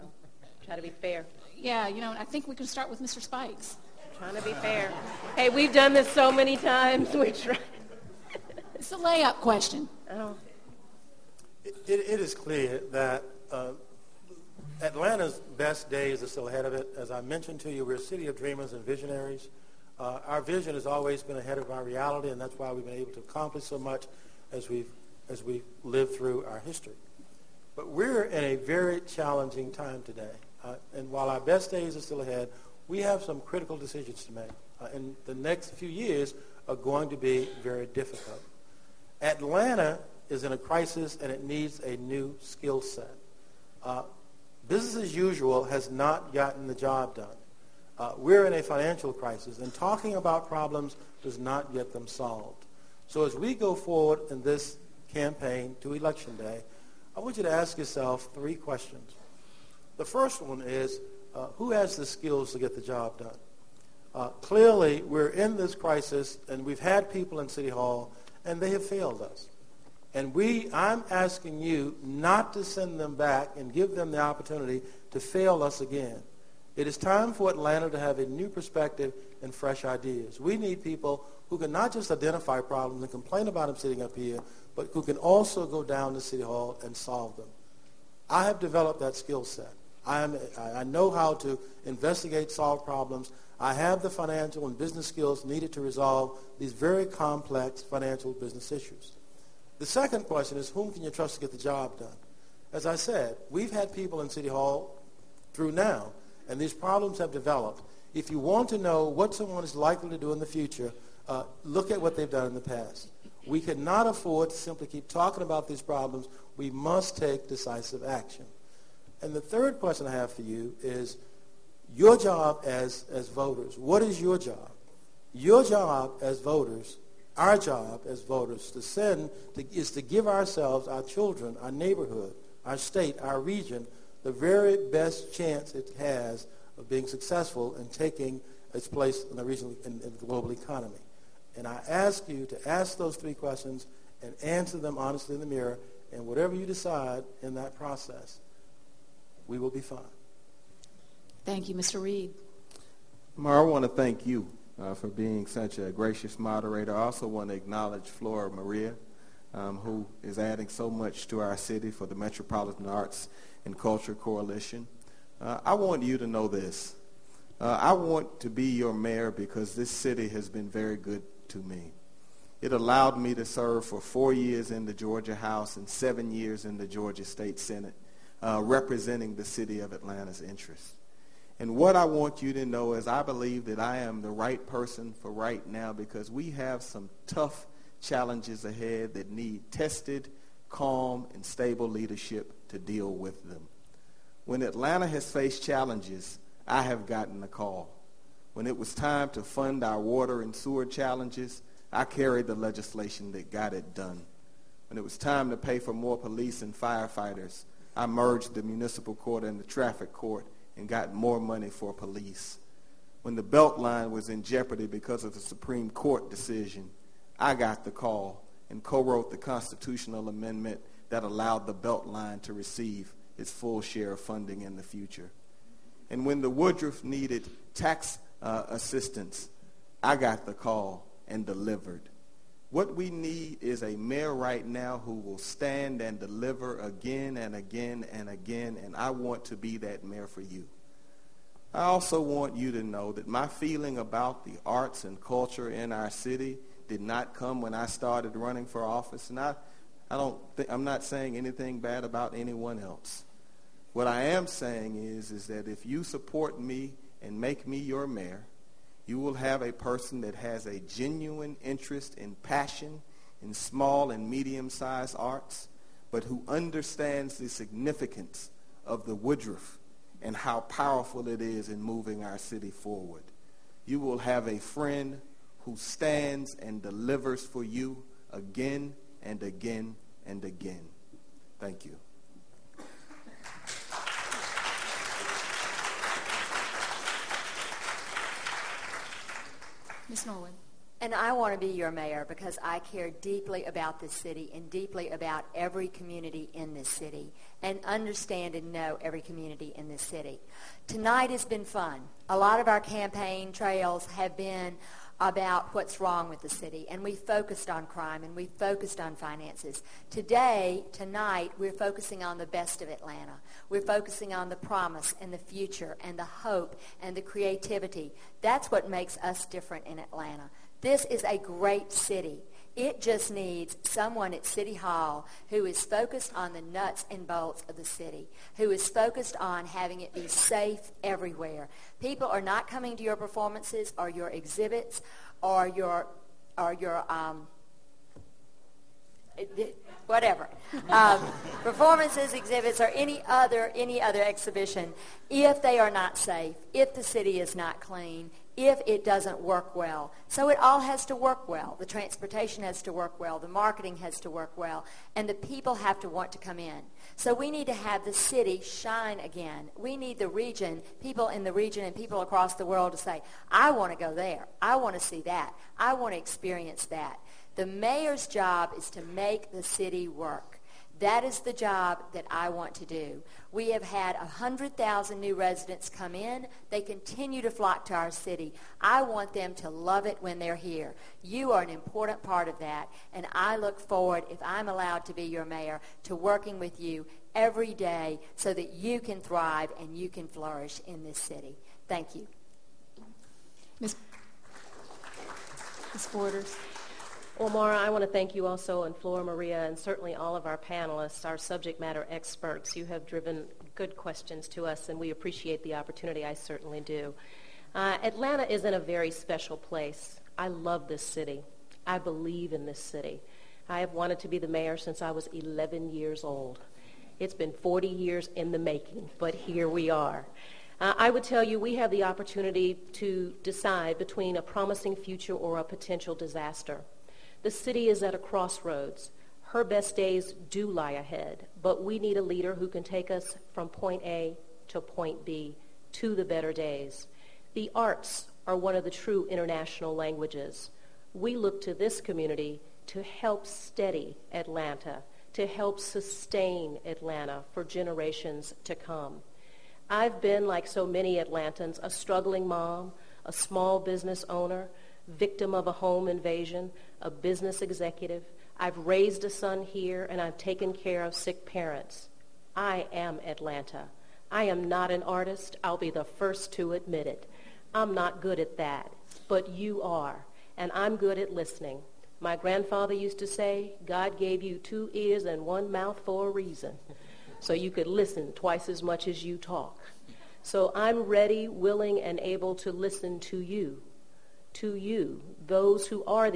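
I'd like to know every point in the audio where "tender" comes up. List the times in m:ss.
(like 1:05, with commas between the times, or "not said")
not said.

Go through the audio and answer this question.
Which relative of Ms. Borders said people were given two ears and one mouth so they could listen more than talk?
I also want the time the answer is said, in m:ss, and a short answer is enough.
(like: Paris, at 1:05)
grandfather, at 7:52.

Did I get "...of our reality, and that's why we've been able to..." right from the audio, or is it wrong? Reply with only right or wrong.
right.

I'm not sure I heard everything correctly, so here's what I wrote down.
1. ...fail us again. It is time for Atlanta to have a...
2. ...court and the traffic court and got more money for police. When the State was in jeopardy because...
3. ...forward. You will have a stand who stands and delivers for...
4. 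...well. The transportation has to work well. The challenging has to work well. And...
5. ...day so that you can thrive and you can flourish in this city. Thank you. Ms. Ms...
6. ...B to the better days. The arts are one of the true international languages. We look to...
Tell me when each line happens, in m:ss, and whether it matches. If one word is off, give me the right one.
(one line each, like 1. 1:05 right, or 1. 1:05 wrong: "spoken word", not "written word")
1. 1:15 right
2. 3:29 wrong: "Beltline", not "State"
3. 4:32 wrong: "friend", not "stand"
4. 5:51 wrong: "marketing", not "challenging"
5. 6:27 right
6. 7:15 right.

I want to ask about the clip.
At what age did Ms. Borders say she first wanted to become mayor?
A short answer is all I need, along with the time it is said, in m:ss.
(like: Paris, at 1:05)
11, at 6:55.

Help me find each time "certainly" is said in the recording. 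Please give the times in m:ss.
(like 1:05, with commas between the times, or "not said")
6:39, 6:46.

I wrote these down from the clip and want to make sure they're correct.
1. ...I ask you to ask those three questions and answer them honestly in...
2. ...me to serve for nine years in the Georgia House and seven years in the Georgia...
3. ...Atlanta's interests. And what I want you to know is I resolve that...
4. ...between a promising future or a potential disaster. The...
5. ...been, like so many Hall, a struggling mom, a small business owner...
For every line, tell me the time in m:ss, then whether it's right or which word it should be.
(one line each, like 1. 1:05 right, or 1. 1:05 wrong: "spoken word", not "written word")
1. 2:21 right
2. 2:53 wrong: "four", not "nine"
3. 2:59 wrong: "believe", not "resolve"
4. 7:03 right
5. 7:30 wrong: "Atlantans", not "Hall".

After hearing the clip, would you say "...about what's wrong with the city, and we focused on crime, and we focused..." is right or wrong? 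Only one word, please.
right.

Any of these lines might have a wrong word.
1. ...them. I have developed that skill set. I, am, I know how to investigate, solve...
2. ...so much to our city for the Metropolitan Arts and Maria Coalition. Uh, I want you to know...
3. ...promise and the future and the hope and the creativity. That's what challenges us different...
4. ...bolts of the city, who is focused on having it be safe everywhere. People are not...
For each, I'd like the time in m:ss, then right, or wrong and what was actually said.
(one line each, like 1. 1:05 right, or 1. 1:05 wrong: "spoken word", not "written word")
1. 1:27 right
2. 2:40 wrong: "Culture", not "Maria"
3. 5:14 wrong: "makes", not "challenges"
4. 5:27 right.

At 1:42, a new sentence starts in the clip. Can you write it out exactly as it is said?
As I said, we've had people in City Hall through now, and these problems have developed.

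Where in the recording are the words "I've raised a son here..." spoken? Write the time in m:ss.
7:38.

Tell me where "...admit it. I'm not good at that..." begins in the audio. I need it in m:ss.
7:46.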